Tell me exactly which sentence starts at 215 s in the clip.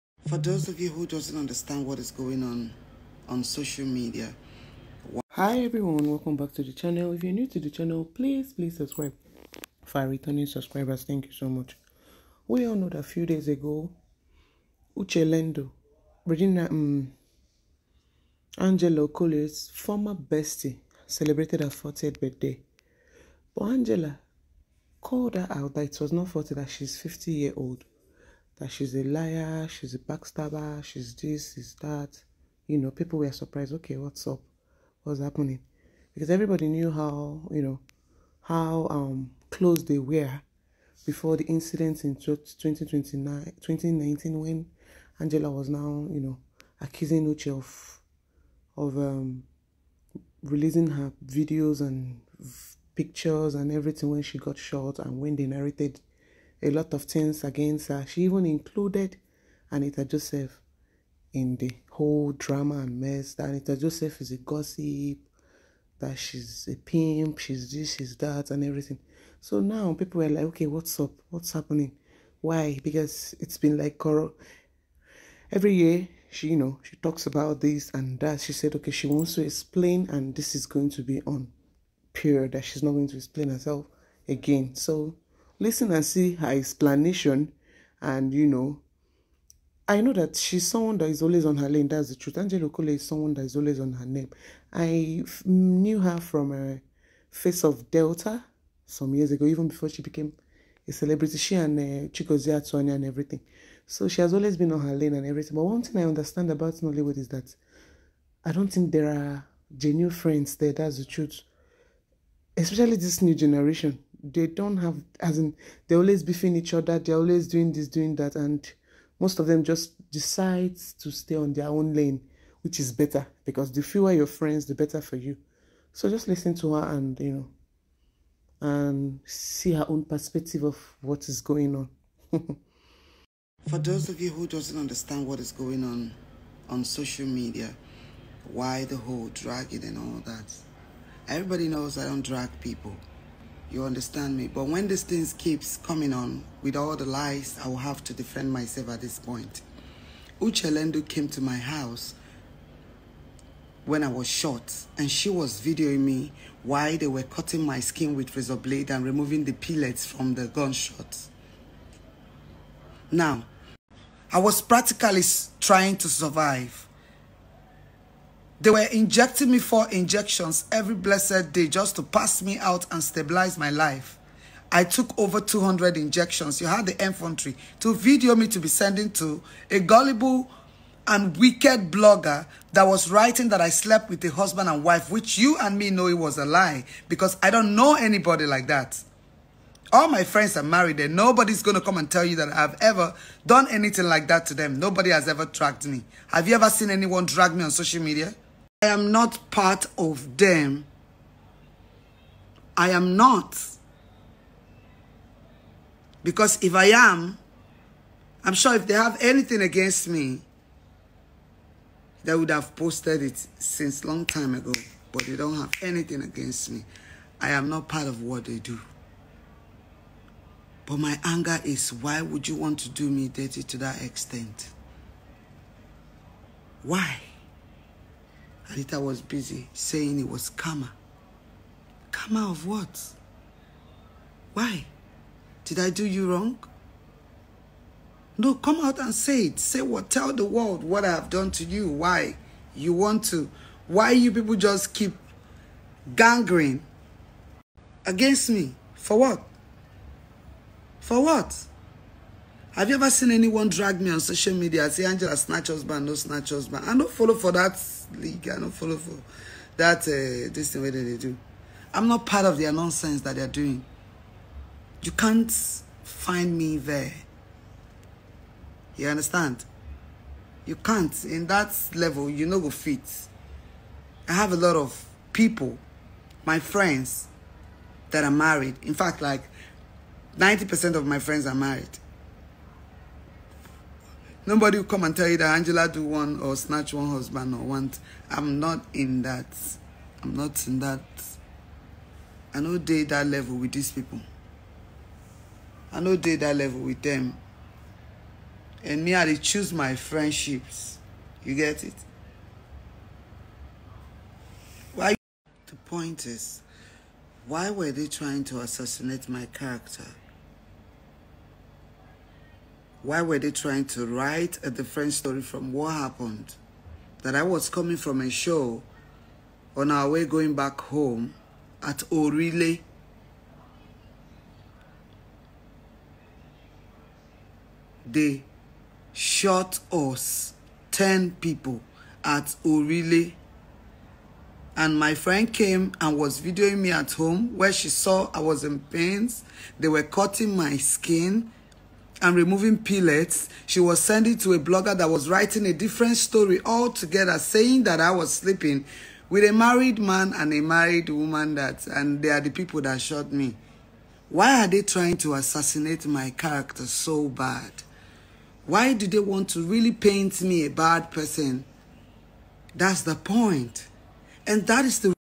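But they don't have anything against me.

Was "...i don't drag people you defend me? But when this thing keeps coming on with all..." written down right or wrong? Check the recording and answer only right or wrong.
wrong.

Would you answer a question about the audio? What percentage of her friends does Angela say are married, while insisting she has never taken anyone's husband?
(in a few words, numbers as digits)
90%.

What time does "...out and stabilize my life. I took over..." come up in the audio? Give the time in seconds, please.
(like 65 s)
172 s.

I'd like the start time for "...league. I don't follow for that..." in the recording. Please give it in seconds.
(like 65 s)
258 s.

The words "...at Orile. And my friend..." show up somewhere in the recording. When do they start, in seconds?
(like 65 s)
332 s.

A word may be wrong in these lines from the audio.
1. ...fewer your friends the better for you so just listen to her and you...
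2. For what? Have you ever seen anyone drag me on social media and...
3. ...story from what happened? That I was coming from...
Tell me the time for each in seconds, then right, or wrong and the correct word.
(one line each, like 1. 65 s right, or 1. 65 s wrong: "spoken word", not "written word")
1. 123 s right
2. 251 s right
3. 315 s right.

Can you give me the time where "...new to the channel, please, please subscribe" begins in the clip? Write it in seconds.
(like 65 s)
7 s.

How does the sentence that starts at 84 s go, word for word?
So listen and see her explanation and you know I know that she's someone that is always on her lane.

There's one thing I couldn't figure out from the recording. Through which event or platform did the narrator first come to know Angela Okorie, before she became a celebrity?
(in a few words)
Face of Delta.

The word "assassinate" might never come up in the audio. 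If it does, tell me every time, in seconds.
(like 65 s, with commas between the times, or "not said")
308 s, 355 s.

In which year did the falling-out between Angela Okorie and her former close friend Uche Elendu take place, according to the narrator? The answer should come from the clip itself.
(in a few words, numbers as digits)
2019.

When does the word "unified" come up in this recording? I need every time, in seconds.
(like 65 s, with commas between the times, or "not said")
not said.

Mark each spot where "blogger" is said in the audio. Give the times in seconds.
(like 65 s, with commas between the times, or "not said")
181 s, 344 s.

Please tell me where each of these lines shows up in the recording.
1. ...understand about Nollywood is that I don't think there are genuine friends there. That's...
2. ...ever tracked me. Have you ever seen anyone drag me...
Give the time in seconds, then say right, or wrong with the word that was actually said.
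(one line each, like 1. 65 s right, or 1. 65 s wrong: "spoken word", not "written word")
1. 106 s right
2. 195 s right.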